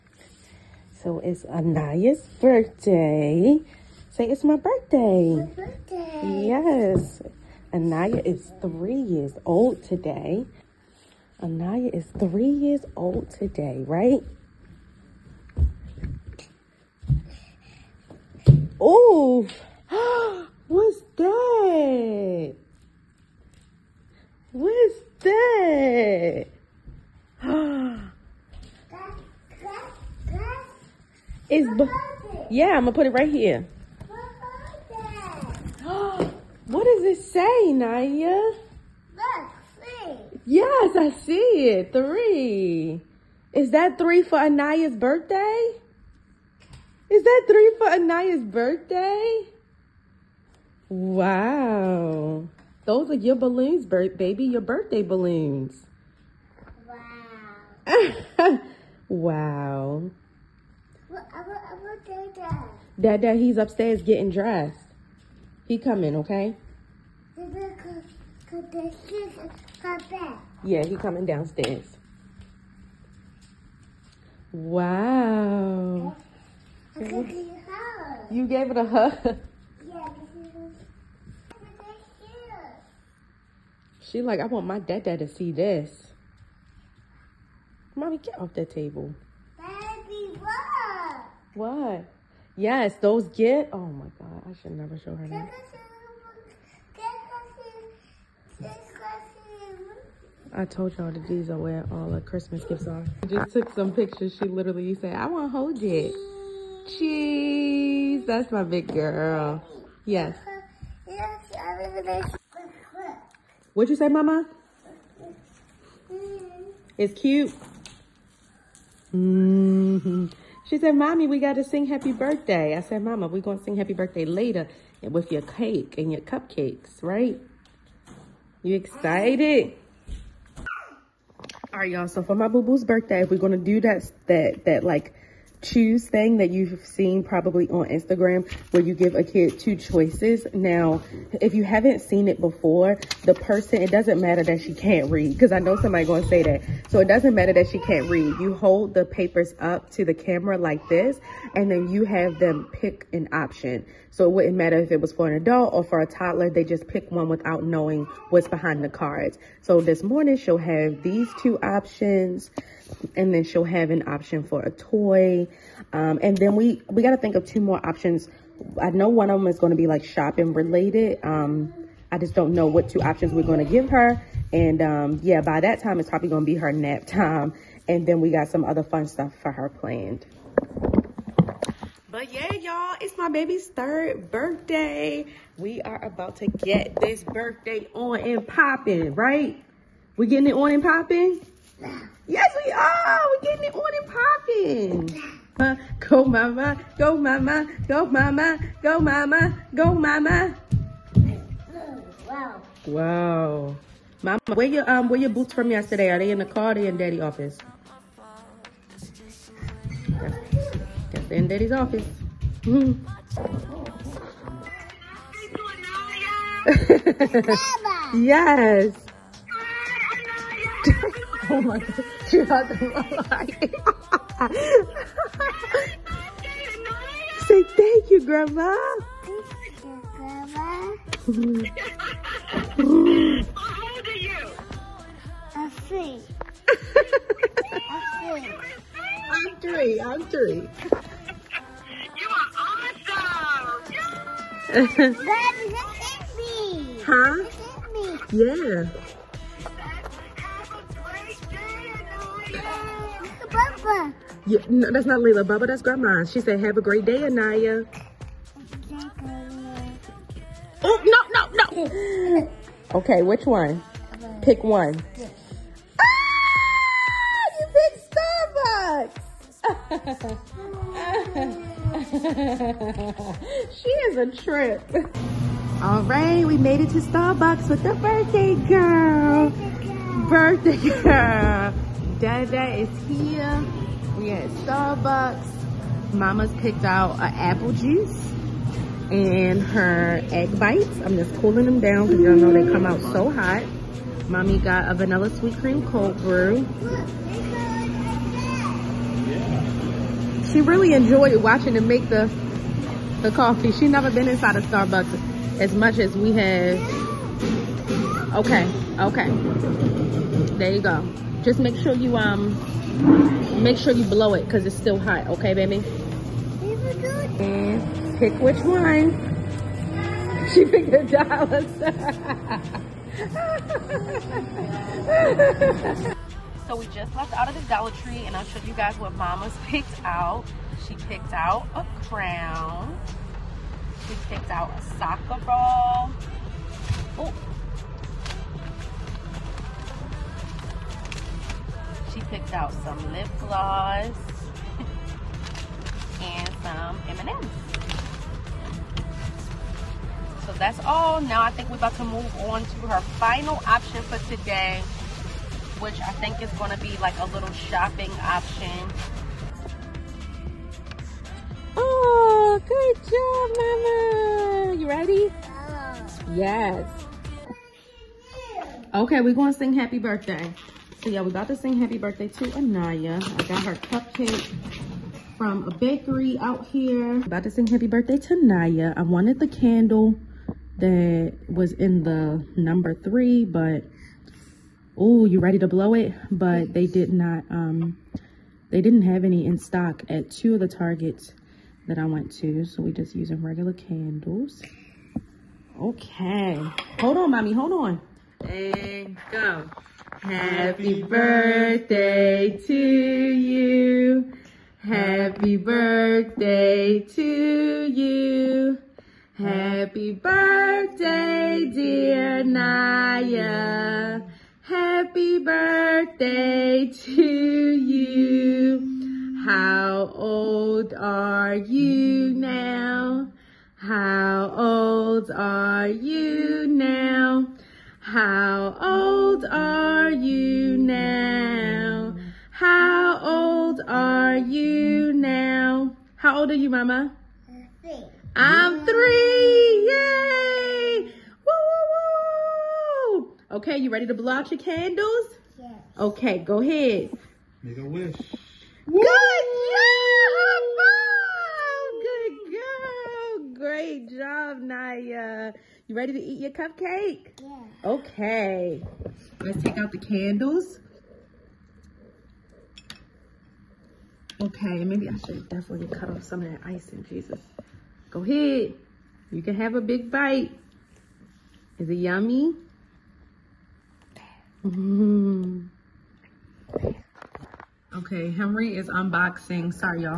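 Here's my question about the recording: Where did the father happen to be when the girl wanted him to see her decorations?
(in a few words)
Upstairs getting dressed.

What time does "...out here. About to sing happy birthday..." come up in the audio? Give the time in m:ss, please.
6:16.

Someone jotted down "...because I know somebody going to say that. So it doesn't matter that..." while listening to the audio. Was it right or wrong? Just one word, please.
right.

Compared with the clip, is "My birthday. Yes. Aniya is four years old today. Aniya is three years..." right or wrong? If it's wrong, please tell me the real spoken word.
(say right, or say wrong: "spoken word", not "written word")
wrong: "three", not "four".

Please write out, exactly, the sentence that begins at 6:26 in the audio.
But they did not, um, they didn't have any in stock at two of the Targets that I went to.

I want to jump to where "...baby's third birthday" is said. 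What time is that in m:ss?
3:03.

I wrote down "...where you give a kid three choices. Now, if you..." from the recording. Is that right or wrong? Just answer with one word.
wrong.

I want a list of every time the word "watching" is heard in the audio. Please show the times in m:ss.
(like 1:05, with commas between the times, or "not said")
5:01.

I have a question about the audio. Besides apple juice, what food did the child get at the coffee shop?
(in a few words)
Egg bites.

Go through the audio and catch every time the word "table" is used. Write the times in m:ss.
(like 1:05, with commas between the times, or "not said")
1:28.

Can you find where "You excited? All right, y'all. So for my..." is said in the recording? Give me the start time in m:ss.
2:08.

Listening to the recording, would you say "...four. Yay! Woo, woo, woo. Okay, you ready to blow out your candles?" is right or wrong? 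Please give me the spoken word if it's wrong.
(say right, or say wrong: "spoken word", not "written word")
wrong: "three", not "four".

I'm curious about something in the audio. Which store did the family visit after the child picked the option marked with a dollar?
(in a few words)
Dollar Tree.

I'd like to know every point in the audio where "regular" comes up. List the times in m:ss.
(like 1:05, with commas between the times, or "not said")
6:33.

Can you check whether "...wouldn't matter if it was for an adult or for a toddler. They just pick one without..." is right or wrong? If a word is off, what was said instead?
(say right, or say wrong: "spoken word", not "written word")
right.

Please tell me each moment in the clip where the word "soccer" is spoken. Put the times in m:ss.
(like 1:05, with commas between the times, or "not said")
5:34.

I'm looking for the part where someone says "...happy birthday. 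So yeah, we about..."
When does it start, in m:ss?
6:09.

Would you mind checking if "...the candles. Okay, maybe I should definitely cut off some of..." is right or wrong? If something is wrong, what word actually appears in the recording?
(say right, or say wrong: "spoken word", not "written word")
right.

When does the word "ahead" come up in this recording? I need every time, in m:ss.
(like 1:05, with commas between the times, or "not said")
7:26, 7:48.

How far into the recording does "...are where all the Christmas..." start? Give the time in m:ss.
1:41.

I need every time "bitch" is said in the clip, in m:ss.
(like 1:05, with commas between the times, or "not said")
not said.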